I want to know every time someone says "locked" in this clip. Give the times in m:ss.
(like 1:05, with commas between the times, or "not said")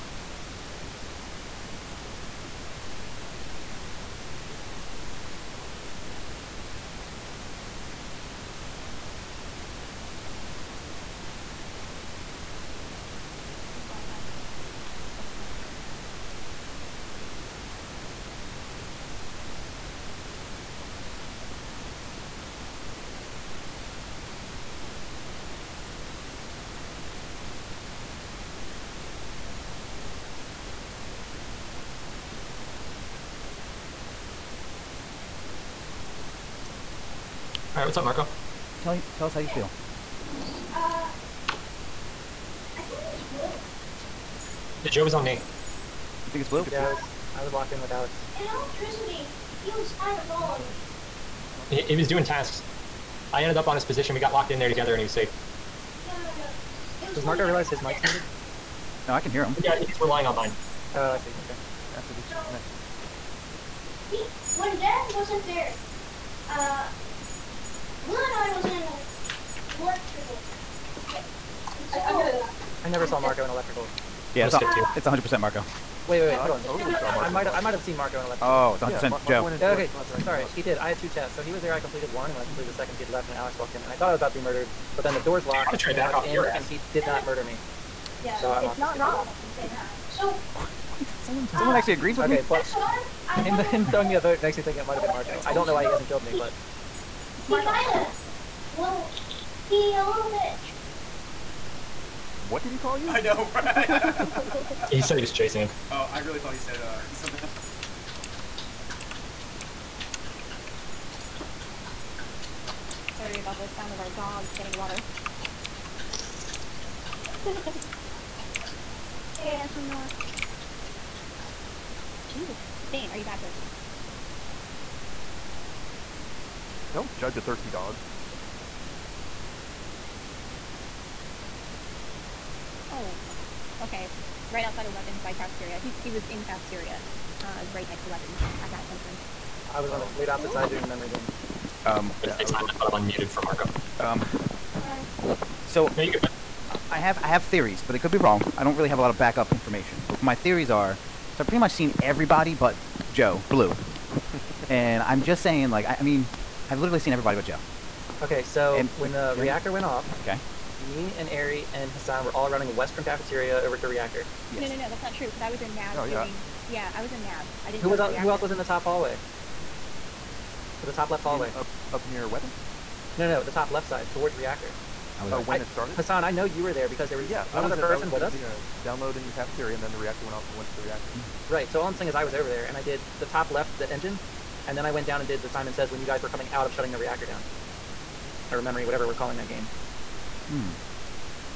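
0:47, 0:54, 1:25.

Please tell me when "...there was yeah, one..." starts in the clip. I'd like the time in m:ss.
2:57.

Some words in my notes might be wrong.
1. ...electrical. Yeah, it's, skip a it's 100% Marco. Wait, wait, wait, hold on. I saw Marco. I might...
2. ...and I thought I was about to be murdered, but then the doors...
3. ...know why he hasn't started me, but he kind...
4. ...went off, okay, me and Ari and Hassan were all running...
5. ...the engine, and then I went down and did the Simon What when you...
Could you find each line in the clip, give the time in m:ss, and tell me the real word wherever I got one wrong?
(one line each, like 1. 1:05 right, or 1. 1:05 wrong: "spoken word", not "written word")
1. 1:13 right
2. 1:23 right
3. 1:35 wrong: "killed", not "started"
4. 2:39 right
5. 3:03 wrong: "Says", not "What".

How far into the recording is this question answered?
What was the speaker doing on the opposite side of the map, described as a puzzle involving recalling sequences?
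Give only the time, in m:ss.
2:20.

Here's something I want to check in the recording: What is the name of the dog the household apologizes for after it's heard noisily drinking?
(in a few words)
Bane.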